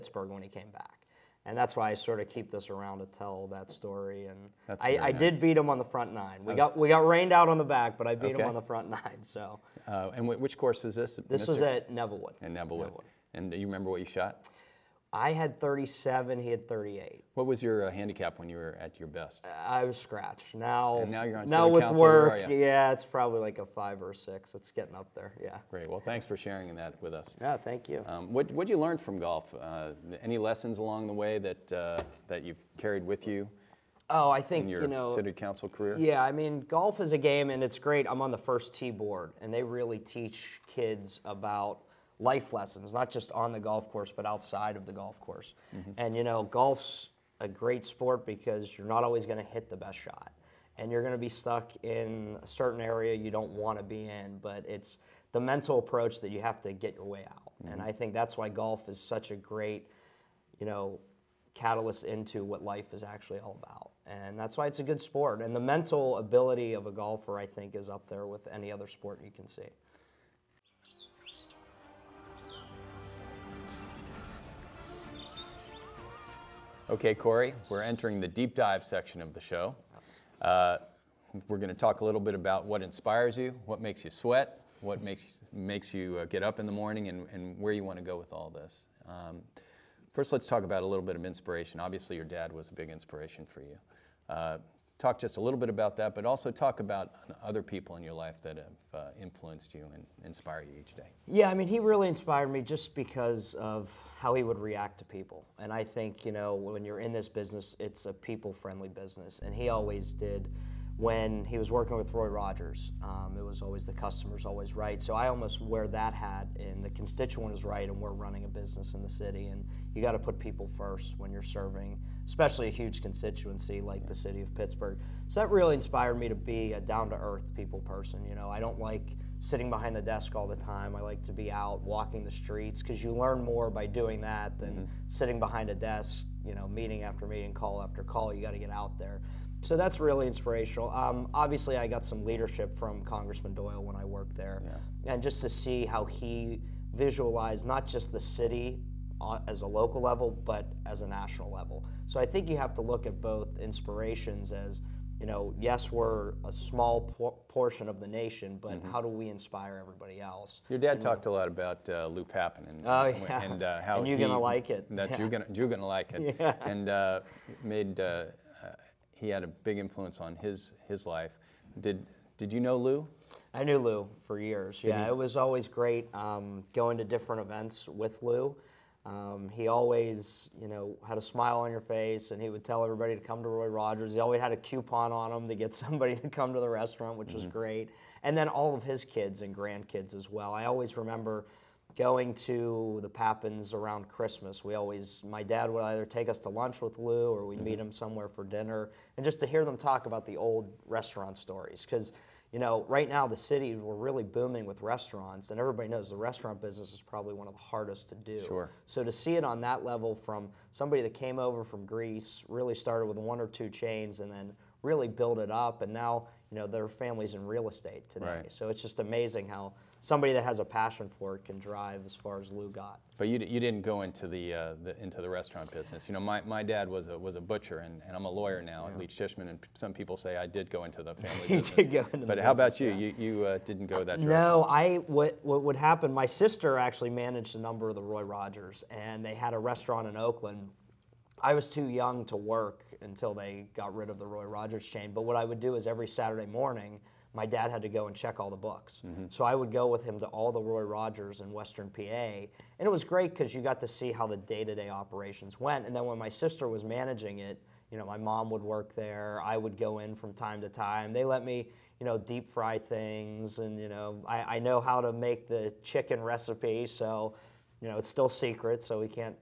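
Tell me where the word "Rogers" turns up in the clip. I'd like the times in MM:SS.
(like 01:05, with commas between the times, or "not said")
01:52, 03:03, 03:58, 04:04, 04:10.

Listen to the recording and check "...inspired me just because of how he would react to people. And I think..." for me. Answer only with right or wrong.
right.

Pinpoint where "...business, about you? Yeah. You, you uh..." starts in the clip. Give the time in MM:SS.
03:52.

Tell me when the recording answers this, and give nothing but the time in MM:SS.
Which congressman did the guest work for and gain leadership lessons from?
02:23.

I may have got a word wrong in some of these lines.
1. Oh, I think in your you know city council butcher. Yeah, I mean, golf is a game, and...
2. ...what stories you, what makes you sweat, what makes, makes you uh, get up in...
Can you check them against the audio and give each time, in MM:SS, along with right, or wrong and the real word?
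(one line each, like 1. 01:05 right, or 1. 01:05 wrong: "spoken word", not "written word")
1. 00:34 wrong: "career", not "butcher"
2. 01:22 wrong: "inspires", not "stories".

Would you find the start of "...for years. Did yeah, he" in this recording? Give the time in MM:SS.
02:54.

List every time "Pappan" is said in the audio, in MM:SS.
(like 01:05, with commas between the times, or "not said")
02:42, 03:13.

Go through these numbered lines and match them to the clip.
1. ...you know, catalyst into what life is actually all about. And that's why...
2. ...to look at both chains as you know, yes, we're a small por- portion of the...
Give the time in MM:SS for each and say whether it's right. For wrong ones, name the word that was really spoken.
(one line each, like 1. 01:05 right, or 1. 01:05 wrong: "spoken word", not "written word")
1. 01:00 right
2. 02:32 wrong: "inspirations", not "chains".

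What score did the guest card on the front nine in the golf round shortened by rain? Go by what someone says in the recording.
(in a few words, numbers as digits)
37.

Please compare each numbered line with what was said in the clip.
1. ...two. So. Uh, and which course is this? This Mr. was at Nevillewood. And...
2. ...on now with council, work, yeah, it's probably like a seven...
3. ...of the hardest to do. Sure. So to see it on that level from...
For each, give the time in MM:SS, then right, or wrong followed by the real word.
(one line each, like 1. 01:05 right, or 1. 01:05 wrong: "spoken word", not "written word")
1. 00:08 wrong: "nine", not "two"
2. 00:21 wrong: "five", not "seven"
3. 03:27 right.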